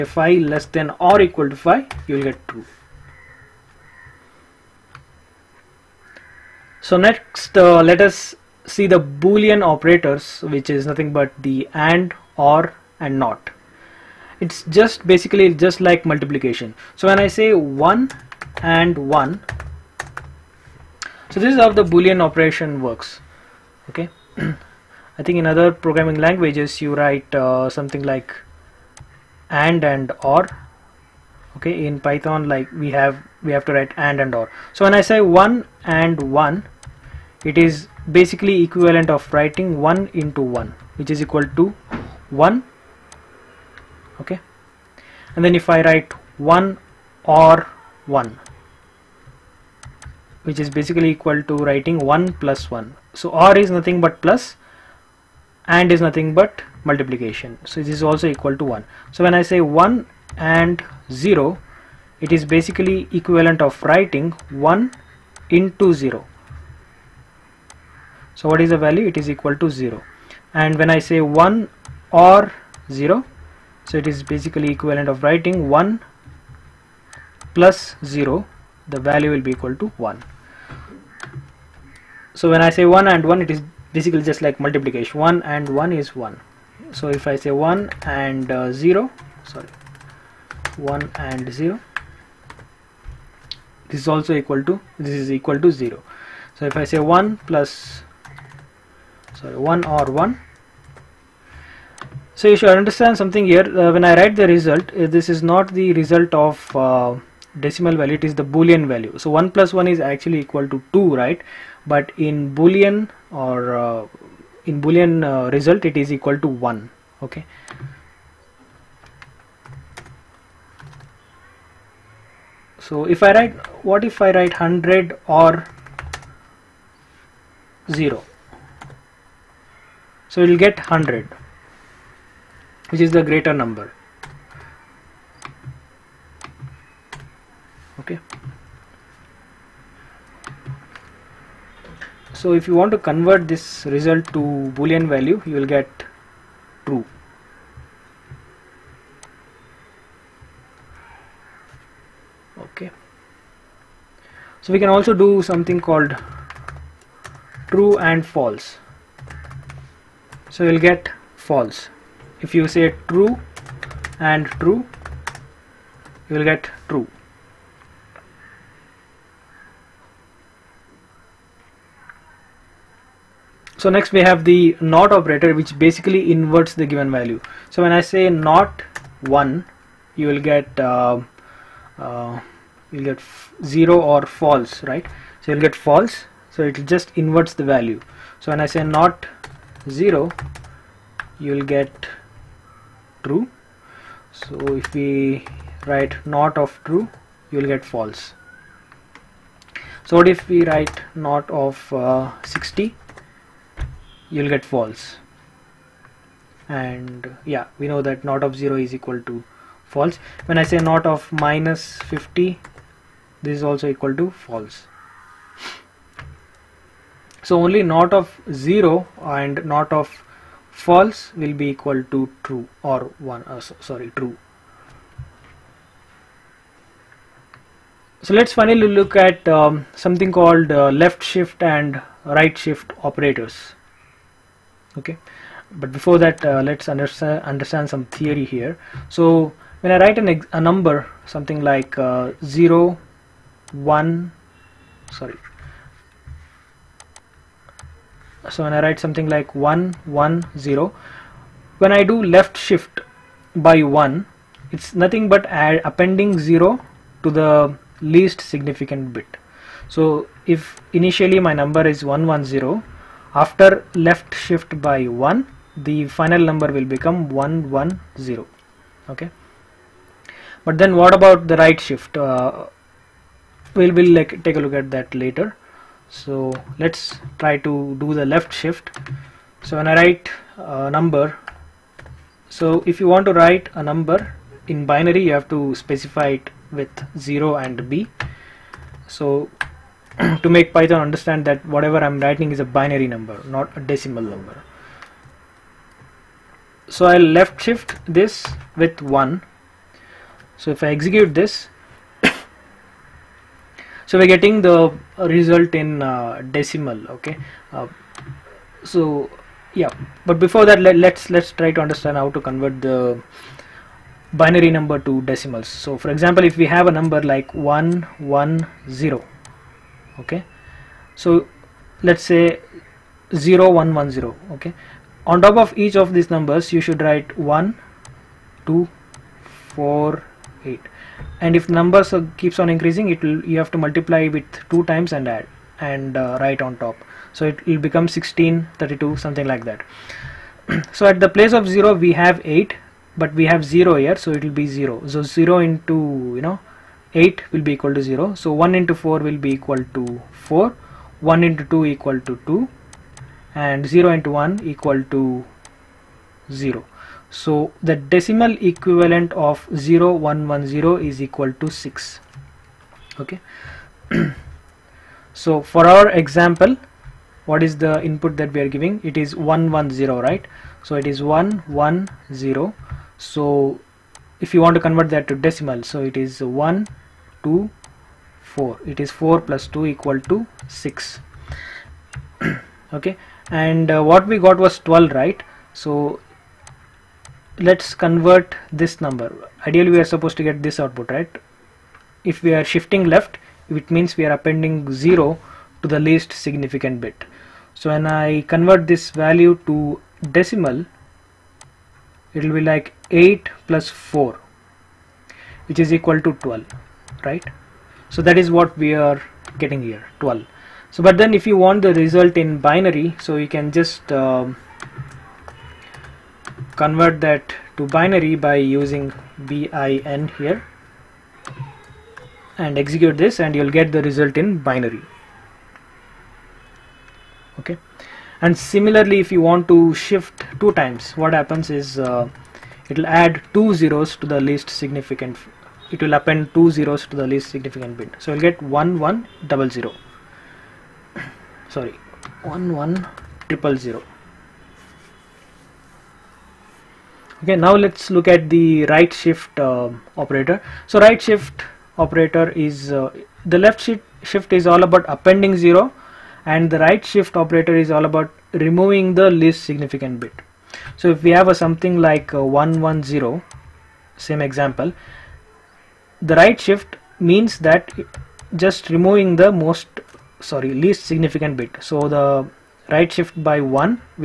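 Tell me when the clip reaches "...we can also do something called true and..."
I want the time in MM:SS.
02:34.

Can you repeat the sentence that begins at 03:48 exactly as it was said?
So let's finally look at um, something called uh, left shift and right shift operators.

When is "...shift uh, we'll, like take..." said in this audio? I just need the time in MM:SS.
04:31.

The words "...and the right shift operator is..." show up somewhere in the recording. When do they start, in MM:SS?
07:36.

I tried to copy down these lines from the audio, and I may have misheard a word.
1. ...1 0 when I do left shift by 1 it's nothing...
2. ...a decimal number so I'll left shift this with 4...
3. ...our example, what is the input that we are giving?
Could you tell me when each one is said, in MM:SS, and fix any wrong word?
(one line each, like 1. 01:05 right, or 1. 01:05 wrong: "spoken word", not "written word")
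1. 04:10 right
2. 04:53 wrong: "1", not "4"
3. 06:05 right.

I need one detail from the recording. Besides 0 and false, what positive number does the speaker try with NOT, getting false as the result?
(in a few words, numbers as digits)
60.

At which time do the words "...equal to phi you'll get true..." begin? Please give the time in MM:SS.
00:01.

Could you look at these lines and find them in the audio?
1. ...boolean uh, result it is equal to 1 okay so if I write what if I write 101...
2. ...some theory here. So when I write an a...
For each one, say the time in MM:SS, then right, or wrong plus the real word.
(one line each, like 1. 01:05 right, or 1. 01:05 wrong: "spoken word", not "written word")
1. 01:54 wrong: "100", not "101"
2. 03:57 right.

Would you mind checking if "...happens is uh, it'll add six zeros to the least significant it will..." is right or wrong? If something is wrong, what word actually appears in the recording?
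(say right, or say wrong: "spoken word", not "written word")
wrong: "two", not "six".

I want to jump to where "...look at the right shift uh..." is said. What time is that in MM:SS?
07:28.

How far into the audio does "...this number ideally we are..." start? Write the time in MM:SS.
06:28.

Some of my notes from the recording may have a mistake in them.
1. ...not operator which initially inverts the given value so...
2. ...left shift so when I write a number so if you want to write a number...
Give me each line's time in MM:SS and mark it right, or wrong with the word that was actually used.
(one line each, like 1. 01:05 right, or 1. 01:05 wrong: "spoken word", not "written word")
1. 02:54 wrong: "basically", not "initially"
2. 04:38 right.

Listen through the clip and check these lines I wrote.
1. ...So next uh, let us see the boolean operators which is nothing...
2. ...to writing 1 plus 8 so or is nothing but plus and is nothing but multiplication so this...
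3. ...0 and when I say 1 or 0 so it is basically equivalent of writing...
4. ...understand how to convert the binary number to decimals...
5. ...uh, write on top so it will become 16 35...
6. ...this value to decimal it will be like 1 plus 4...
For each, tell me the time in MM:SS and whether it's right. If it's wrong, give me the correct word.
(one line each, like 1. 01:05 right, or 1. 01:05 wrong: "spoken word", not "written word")
1. 00:06 right
2. 00:51 wrong: "1", not "8"
3. 01:09 right
4. 05:11 right
5. 05:36 wrong: "32", not "35"
6. 06:38 wrong: "8", not "1".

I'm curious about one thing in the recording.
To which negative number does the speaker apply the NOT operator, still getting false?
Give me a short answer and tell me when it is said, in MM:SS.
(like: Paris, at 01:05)
-50, at 03:31.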